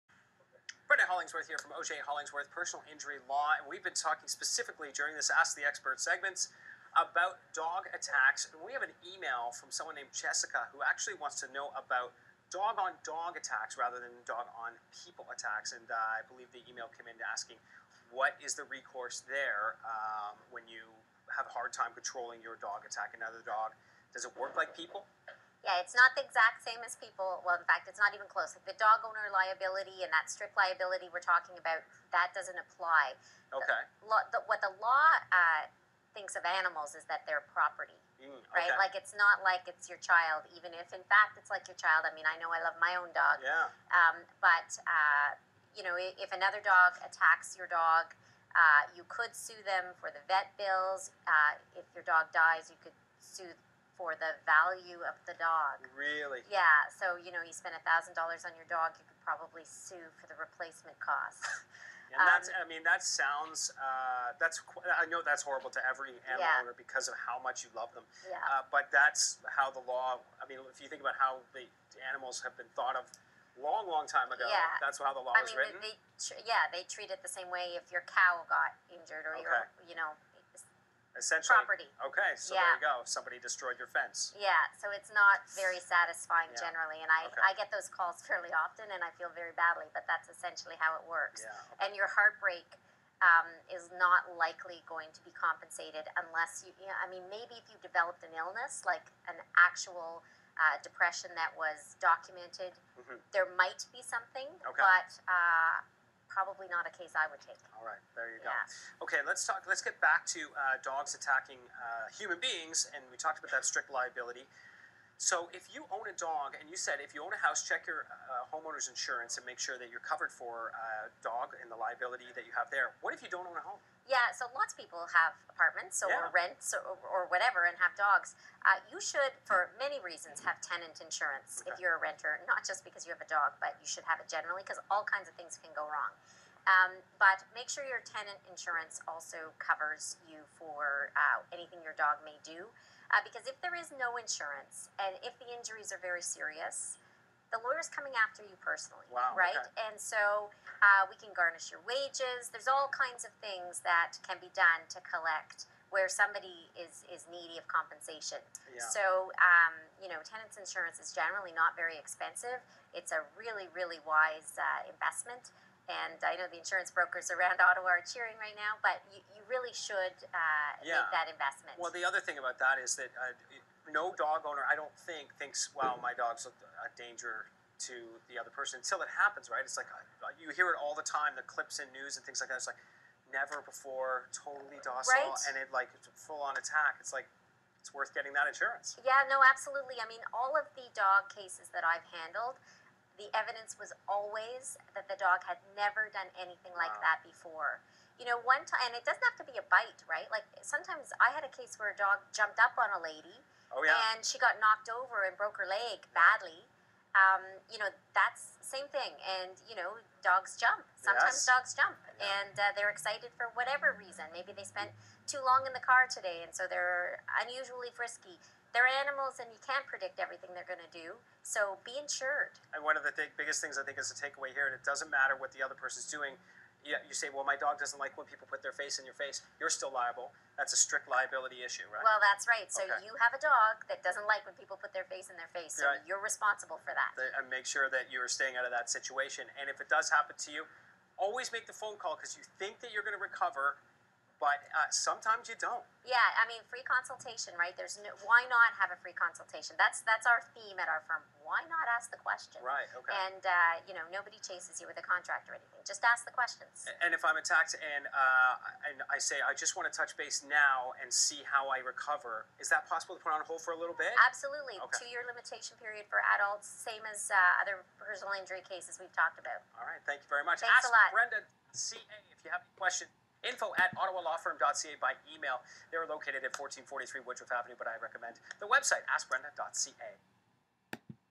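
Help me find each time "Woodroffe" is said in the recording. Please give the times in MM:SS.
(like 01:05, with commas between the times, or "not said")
04:37.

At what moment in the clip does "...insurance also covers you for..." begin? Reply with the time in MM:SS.
02:18.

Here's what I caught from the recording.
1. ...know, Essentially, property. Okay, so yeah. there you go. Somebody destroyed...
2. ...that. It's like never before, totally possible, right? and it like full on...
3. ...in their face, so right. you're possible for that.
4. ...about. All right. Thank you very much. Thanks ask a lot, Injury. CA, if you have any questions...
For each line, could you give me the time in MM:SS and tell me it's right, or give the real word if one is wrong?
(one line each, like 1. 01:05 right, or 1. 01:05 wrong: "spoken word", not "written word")
1. 01:19 right
2. 03:02 wrong: "docile", not "possible"
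3. 03:55 wrong: "responsible", not "possible"
4. 04:29 wrong: "Brenda", not "Injury".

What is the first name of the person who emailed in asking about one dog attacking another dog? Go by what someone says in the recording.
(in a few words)
Jessica.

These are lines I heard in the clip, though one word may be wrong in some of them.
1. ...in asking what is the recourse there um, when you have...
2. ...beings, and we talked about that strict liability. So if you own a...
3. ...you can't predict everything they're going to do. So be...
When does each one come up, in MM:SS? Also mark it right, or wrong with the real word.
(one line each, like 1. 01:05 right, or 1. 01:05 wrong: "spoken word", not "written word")
1. 00:17 right
2. 01:52 right
3. 03:39 right.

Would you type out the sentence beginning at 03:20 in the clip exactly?
Like sometimes I had a case where a dog jumped up on a lady, oh, yeah.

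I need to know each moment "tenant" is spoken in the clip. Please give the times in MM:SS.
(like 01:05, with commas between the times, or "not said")
02:10, 02:18, 02:40.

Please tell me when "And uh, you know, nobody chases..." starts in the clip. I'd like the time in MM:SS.
04:13.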